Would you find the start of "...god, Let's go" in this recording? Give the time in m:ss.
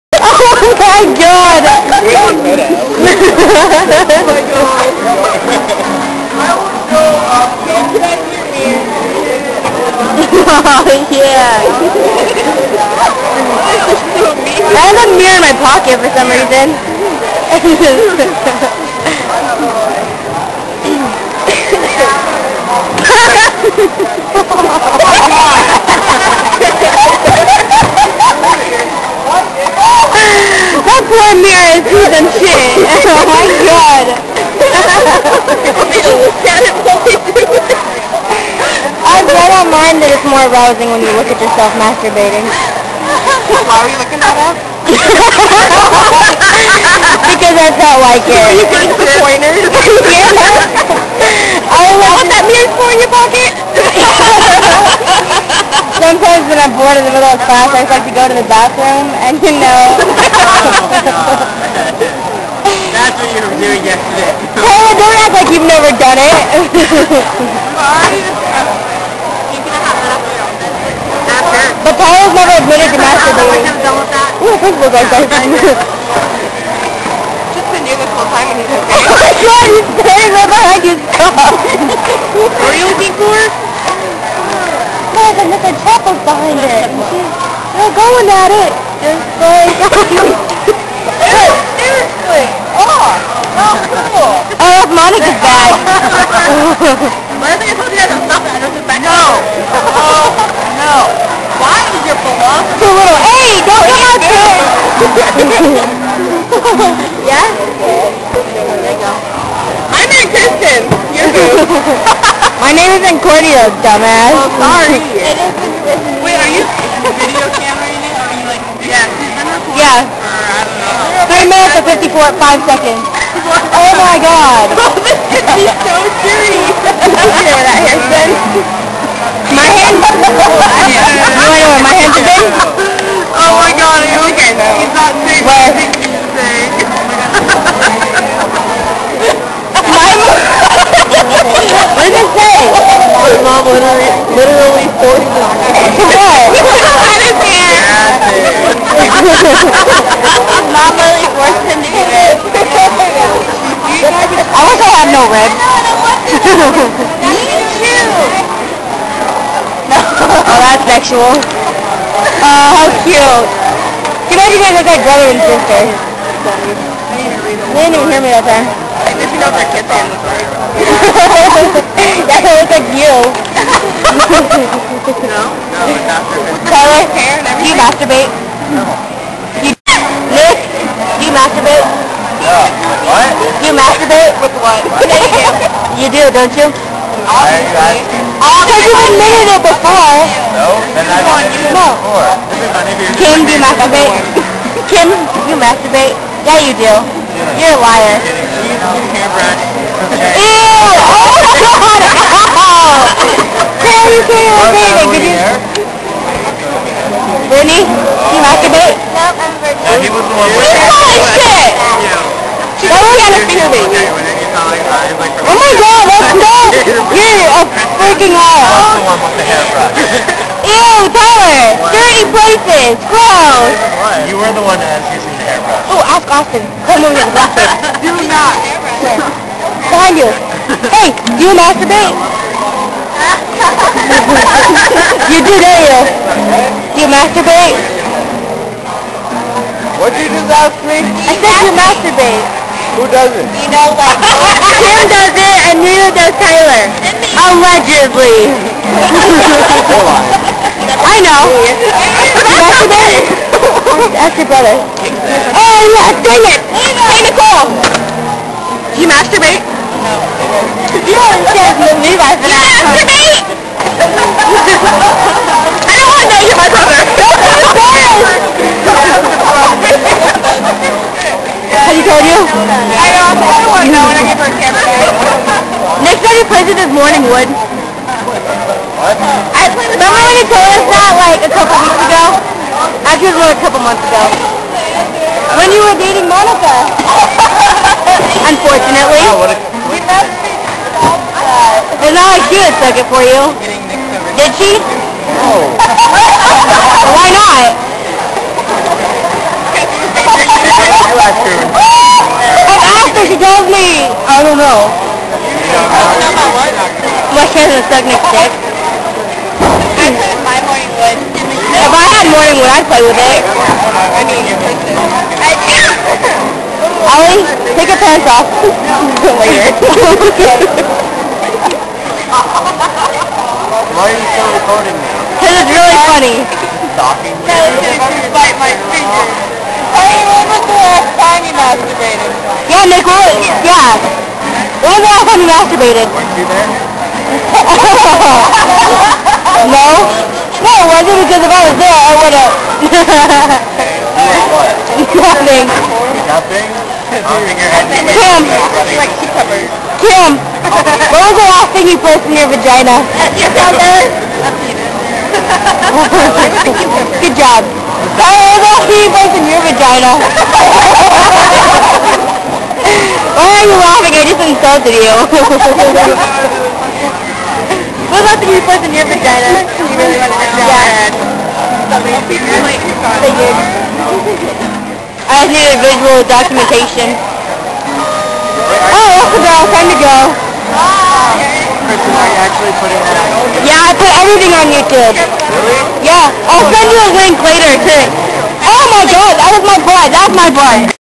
3:35.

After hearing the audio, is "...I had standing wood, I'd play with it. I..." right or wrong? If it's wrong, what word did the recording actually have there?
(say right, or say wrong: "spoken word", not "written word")
wrong: "morning", not "standing".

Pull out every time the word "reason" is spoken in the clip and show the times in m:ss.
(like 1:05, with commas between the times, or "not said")
0:16.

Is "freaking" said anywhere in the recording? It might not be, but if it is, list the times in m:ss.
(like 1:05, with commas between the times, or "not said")
3:38.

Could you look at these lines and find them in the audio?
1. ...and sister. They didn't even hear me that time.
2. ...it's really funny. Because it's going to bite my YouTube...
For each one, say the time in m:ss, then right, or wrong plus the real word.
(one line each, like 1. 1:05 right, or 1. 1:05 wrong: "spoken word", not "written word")
1. 2:45 right
2. 5:25 wrong: "Yeah", not "YouTube".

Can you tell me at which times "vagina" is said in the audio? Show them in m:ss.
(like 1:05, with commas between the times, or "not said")
5:52, 5:59, 6:09.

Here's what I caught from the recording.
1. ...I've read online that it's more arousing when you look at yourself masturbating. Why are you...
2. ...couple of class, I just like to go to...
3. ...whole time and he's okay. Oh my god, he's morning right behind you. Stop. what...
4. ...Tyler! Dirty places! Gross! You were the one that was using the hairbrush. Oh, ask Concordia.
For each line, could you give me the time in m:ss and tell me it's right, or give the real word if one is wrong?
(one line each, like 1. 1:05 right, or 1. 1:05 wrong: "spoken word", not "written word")
1. 0:39 right
2. 0:57 wrong: "middle", not "couple"
3. 1:18 wrong: "standing", not "morning"
4. 3:41 wrong: "Austin", not "Concordia".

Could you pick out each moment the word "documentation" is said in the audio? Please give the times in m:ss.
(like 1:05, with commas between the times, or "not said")
6:16.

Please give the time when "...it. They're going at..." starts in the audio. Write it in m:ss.
1:26.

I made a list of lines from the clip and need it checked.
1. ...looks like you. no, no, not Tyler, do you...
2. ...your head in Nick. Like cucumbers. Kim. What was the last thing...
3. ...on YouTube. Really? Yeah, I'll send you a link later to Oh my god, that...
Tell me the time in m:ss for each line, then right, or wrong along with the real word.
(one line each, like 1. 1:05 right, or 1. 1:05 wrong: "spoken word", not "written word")
1. 2:52 right
2. 5:47 wrong: "Kim", not "Nick"
3. 6:24 right.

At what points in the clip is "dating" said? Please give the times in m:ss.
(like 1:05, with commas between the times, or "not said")
4:45.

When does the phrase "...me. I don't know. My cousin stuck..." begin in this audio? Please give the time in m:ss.
5:03.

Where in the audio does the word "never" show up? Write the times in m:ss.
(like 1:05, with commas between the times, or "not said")
1:05, 1:12.